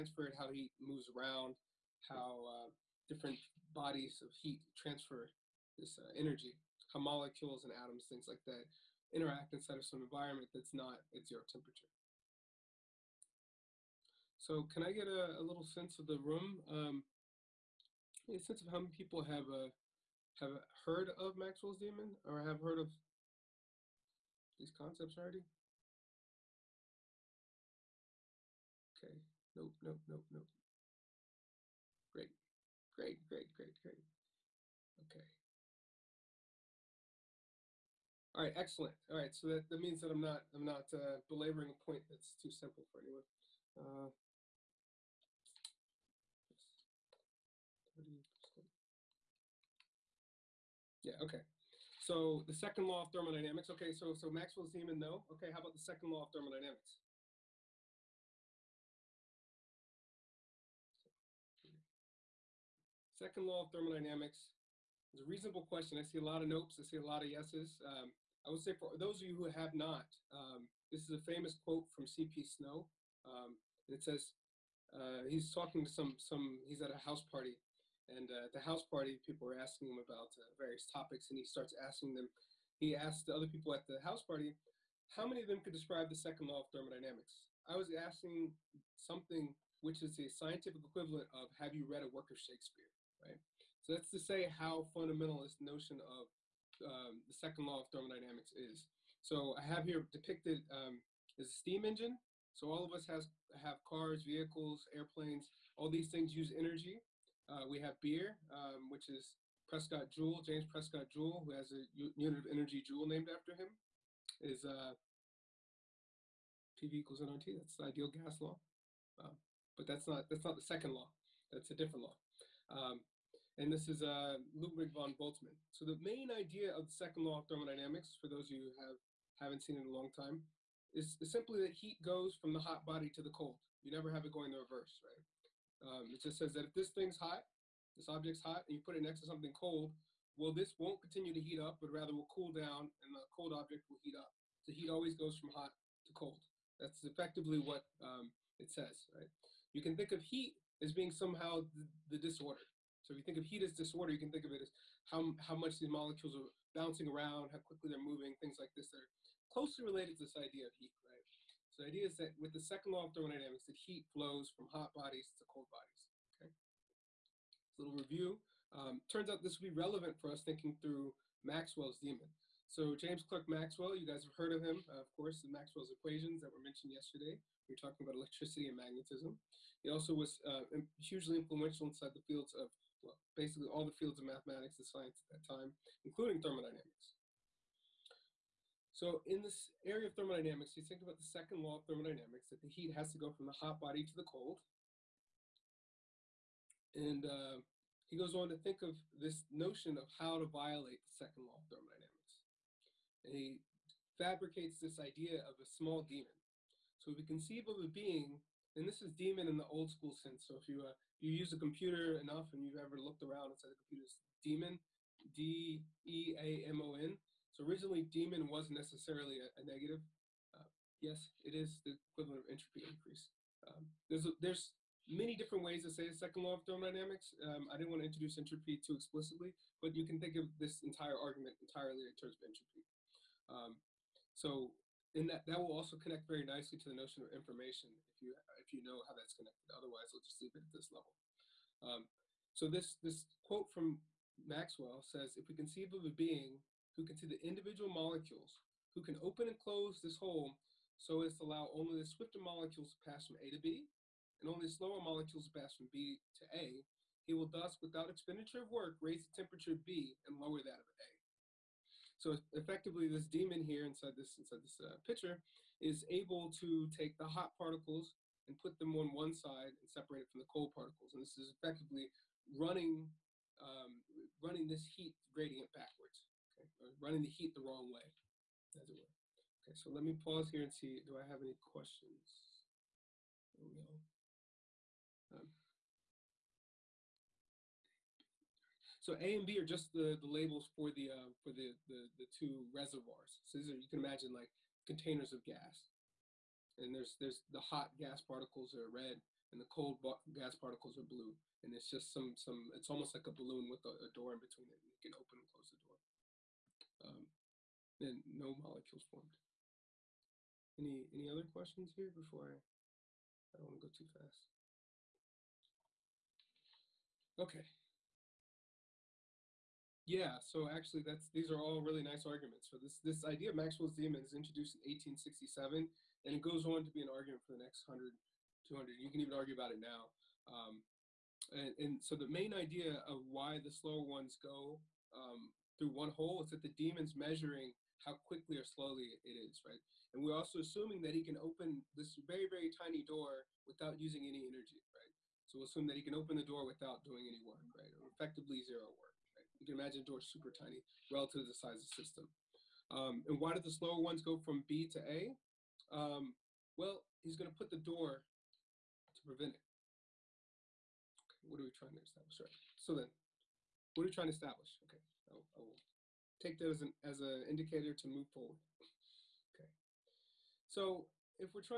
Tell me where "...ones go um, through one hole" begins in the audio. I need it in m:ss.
5:34.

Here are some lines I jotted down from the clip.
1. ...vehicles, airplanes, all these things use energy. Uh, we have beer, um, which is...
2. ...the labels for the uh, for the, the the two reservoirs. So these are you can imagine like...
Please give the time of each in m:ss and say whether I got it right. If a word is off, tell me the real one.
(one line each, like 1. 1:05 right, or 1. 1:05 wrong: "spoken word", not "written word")
1. 1:44 right
2. 4:50 right.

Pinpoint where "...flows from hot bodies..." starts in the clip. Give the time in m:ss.
2:44.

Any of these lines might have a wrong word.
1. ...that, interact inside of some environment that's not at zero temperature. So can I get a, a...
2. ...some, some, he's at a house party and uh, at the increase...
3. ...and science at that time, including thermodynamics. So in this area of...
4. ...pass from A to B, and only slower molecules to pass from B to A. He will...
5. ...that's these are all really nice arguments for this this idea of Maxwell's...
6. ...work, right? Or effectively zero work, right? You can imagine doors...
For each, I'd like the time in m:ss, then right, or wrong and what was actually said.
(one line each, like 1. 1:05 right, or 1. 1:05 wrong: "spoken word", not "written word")
1. 0:08 right
2. 1:15 wrong: "house", not "increase"
3. 3:04 right
4. 4:13 right
5. 5:21 right
6. 5:47 right.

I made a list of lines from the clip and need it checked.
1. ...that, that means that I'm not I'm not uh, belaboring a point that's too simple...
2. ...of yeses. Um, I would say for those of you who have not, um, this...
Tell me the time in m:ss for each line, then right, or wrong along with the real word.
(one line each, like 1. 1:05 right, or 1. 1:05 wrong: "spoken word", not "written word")
1. 0:39 right
2. 1:07 right.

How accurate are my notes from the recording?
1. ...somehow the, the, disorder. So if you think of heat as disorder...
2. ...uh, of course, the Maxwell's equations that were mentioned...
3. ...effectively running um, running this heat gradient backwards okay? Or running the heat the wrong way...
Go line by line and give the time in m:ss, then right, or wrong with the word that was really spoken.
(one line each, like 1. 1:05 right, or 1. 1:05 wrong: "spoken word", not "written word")
1. 2:31 right
2. 2:54 right
3. 4:31 right.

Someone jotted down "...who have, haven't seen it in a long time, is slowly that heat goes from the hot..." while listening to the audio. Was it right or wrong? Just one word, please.
wrong.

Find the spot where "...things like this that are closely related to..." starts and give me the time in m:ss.
2:38.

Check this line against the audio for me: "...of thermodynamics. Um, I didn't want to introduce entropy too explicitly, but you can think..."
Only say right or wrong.
right.